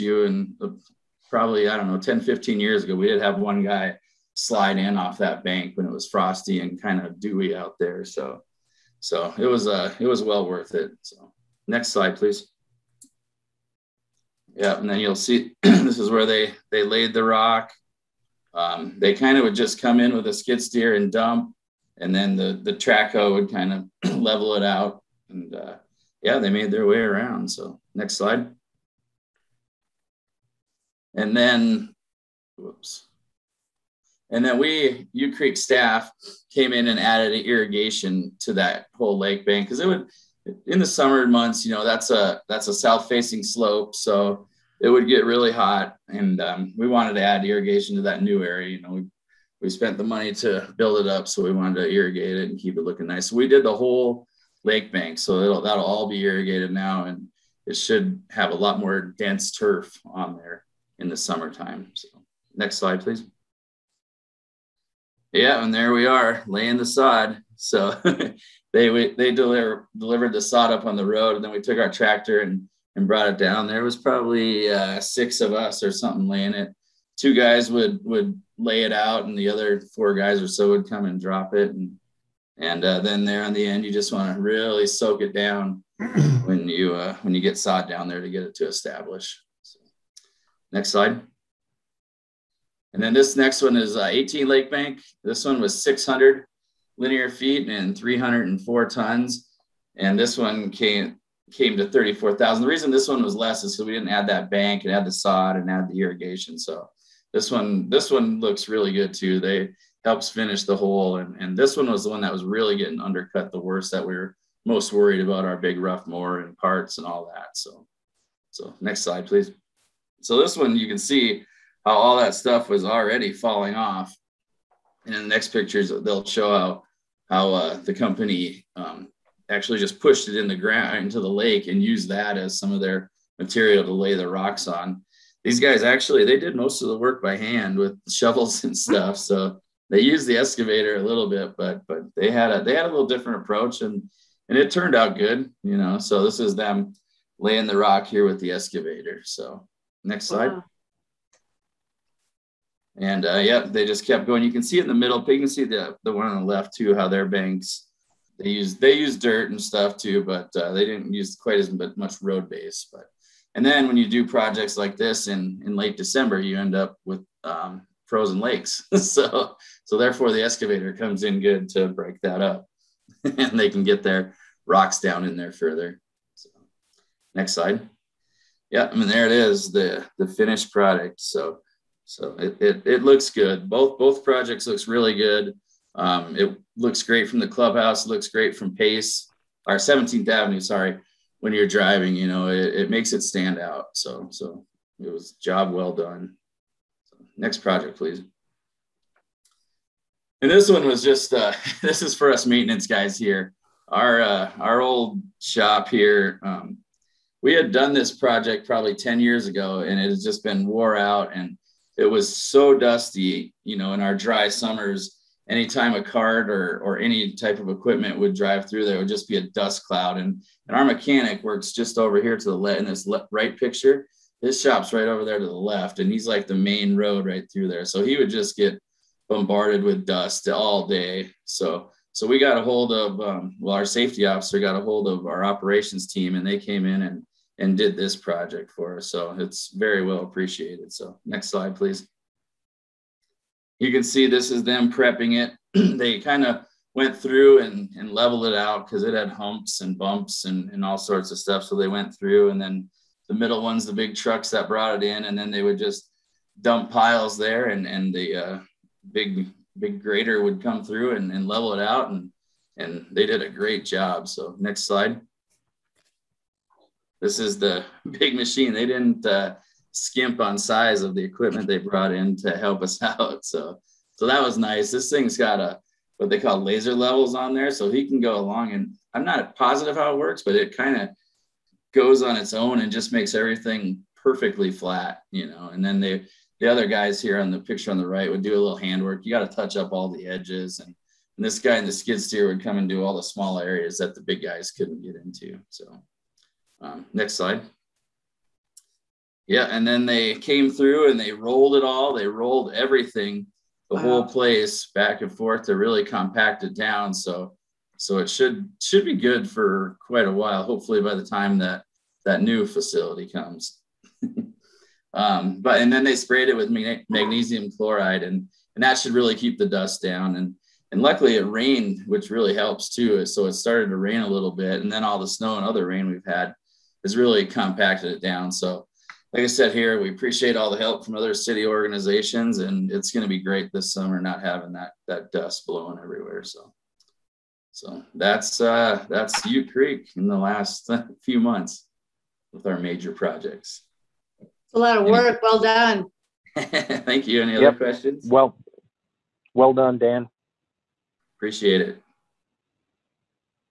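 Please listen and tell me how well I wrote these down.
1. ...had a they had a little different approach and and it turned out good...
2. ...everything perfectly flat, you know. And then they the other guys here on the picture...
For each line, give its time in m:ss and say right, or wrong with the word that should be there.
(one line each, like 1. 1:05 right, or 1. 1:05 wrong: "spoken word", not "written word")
1. 2:22 right
2. 4:43 right.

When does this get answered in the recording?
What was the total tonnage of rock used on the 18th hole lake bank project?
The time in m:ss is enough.
1:37.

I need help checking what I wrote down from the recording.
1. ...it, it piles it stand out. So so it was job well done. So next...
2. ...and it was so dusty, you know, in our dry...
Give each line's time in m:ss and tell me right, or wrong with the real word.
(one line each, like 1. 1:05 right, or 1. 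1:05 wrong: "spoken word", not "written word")
1. 3:12 wrong: "makes", not "piles"
2. 3:31 right.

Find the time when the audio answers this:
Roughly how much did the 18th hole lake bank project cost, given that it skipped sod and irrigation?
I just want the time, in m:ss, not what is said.
1:41.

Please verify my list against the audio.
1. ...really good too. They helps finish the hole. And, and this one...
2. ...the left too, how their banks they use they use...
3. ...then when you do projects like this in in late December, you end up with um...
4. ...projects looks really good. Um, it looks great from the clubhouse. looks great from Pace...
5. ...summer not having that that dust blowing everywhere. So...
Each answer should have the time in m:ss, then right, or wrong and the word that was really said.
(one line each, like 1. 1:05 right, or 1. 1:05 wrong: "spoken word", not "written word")
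1. 1:48 right
2. 2:36 right
3. 2:43 right
4. 3:04 right
5. 5:33 right.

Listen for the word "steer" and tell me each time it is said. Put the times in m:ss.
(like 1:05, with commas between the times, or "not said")
0:20, 4:52.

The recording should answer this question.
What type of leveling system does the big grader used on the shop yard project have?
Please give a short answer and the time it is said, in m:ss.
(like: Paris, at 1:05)
Laser levels, at 4:36.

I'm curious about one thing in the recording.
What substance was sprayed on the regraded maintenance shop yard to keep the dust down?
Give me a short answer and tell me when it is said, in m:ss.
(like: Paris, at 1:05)
Magnesium chloride, at 5:17.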